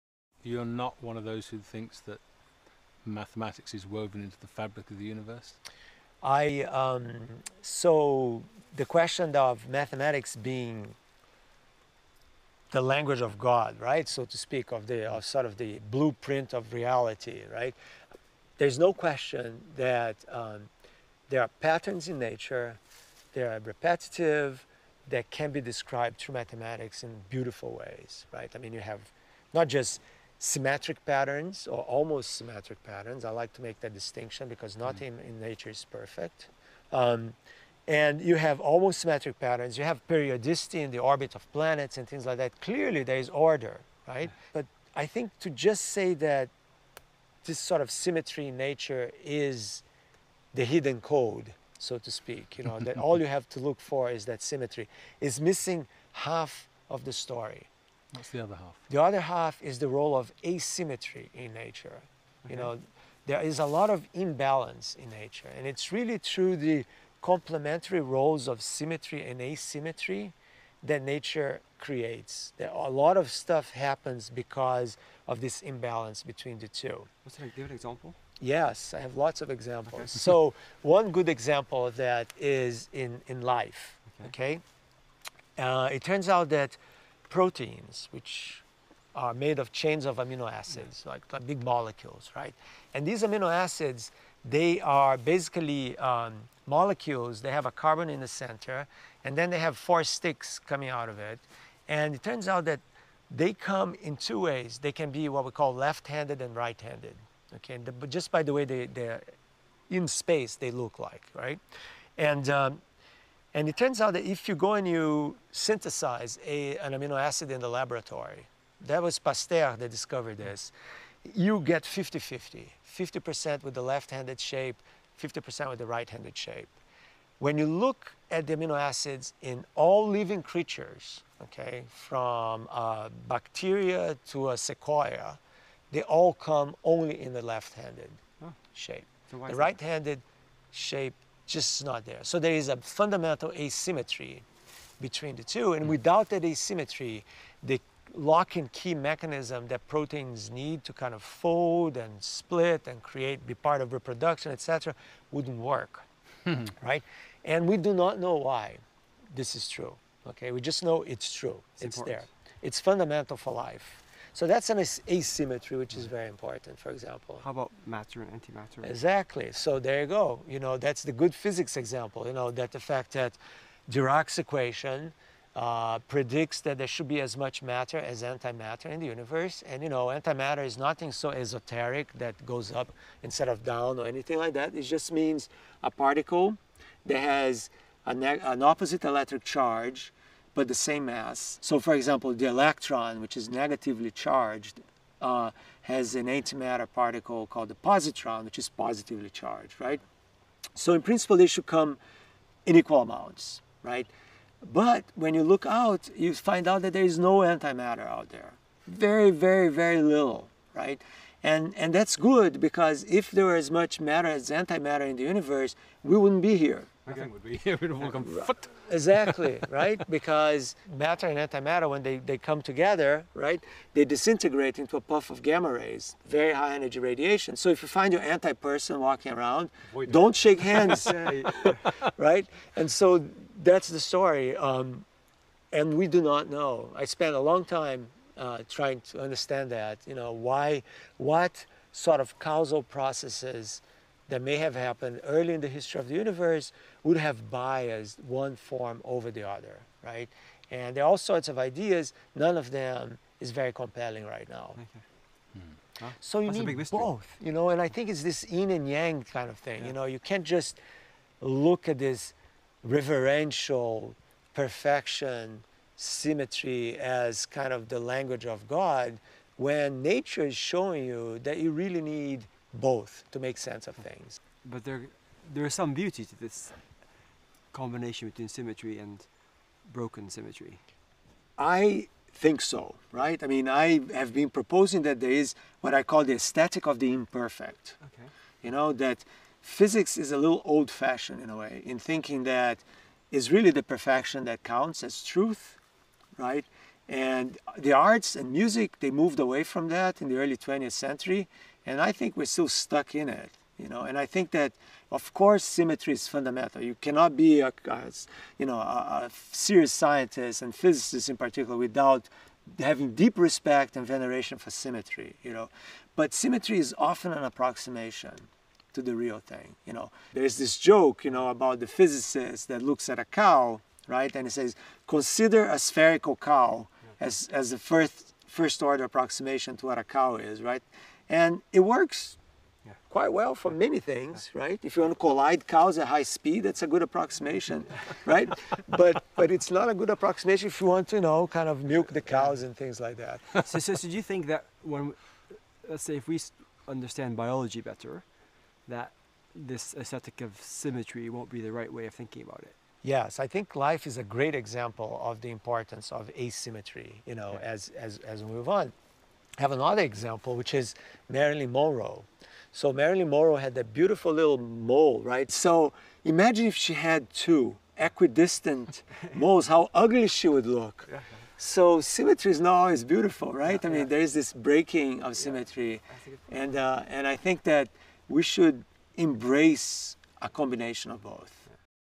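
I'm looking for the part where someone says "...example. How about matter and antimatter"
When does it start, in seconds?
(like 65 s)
166 s.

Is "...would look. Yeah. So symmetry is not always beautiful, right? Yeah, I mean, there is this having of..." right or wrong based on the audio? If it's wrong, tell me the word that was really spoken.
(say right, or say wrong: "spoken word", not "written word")
wrong: "breaking", not "having".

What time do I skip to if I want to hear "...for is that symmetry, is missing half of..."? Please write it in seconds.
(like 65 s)
53 s.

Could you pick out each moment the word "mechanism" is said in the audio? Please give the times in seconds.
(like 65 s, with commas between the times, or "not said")
148 s.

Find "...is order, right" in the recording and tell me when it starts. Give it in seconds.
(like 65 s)
43 s.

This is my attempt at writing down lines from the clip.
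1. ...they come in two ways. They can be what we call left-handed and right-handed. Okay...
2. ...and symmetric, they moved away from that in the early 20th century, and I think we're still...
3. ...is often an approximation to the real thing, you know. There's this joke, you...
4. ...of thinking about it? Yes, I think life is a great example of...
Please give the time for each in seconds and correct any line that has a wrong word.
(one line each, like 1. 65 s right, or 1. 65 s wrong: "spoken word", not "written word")
1. 103 s right
2. 298 s wrong: "music", not "symmetric"
3. 316 s right
4. 352 s right.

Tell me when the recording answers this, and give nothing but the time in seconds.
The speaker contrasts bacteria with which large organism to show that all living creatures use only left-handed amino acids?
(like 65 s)
134 s.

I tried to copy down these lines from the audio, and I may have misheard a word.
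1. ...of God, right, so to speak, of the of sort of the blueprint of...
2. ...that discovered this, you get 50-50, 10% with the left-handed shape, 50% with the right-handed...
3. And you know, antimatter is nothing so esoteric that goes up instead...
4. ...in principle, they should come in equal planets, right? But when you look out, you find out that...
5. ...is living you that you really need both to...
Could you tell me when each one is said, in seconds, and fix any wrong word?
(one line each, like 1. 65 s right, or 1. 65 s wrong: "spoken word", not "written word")
1. 13 s right
2. 119 s wrong: "50", not "10"
3. 179 s right
4. 200 s wrong: "amounts", not "planets"
5. 270 s wrong: "showing", not "living".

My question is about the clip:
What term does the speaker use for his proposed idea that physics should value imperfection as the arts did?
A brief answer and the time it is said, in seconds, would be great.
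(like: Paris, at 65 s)
aesthetic of the imperfect, at 286 s.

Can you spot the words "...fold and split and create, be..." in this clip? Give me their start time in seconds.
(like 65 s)
151 s.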